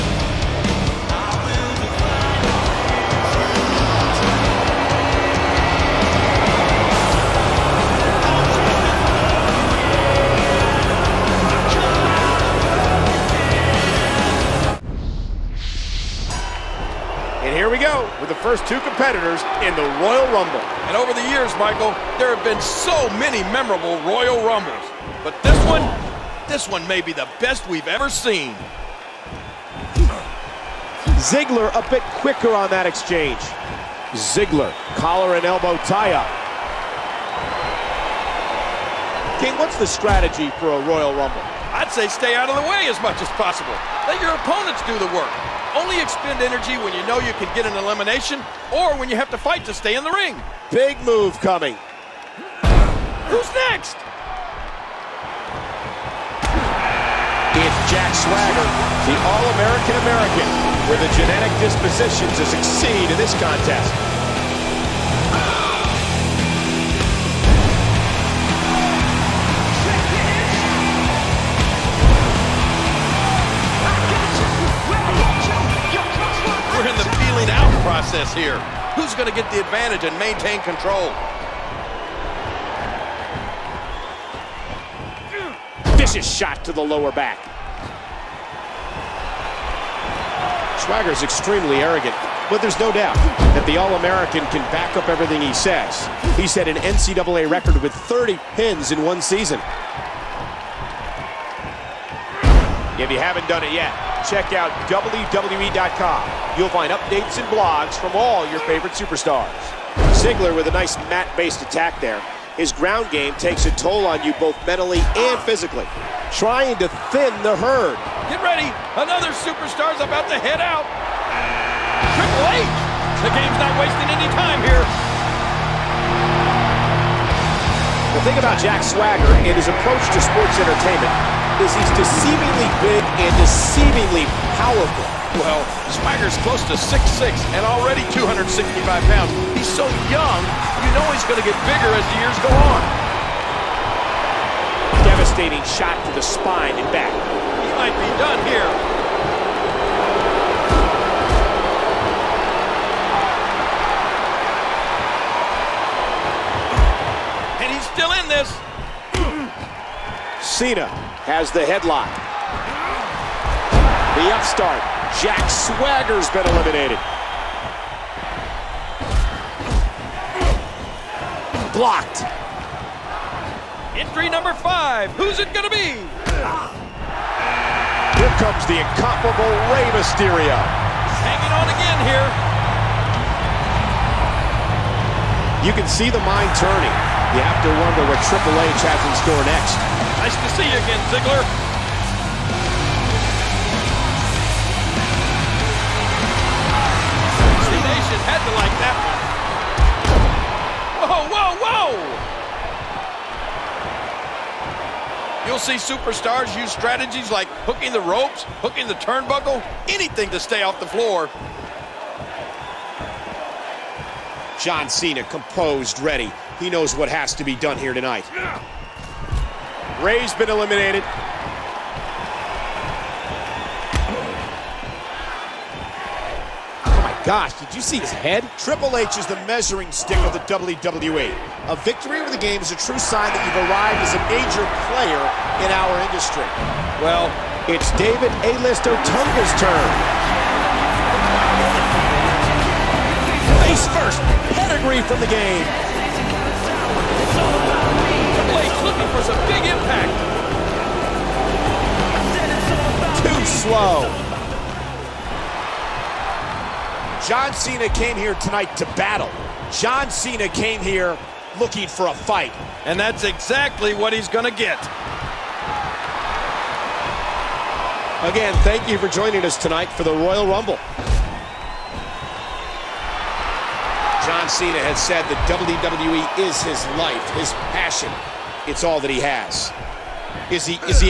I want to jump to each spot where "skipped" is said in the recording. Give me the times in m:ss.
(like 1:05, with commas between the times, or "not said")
not said.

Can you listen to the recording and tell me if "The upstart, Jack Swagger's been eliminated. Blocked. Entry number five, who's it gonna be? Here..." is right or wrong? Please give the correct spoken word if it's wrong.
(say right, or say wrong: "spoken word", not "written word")
right.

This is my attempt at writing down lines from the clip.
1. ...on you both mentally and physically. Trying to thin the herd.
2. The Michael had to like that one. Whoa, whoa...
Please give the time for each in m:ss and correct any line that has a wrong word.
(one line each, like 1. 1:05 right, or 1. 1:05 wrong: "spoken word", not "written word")
1. 1:54 right
2. 3:17 wrong: "Nation", not "Michael".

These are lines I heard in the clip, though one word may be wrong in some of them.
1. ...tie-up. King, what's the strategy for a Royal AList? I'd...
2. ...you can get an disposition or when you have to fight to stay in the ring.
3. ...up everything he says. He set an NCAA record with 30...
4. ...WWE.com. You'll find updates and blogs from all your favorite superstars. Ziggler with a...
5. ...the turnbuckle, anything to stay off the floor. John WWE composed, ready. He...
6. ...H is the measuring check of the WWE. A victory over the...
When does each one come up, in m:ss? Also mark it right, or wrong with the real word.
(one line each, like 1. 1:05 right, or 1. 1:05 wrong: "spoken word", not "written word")
1. 0:35 wrong: "Rumble", not "AList"
2. 0:47 wrong: "elimination", not "disposition"
3. 1:34 right
4. 1:44 right
5. 3:28 wrong: "Cena", not "WWE"
6. 3:48 wrong: "stick", not "check".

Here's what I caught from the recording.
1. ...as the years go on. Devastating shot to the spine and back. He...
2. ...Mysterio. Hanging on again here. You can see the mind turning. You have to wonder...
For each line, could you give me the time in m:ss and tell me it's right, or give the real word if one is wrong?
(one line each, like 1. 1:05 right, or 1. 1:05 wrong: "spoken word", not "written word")
1. 2:21 right
2. 2:59 right.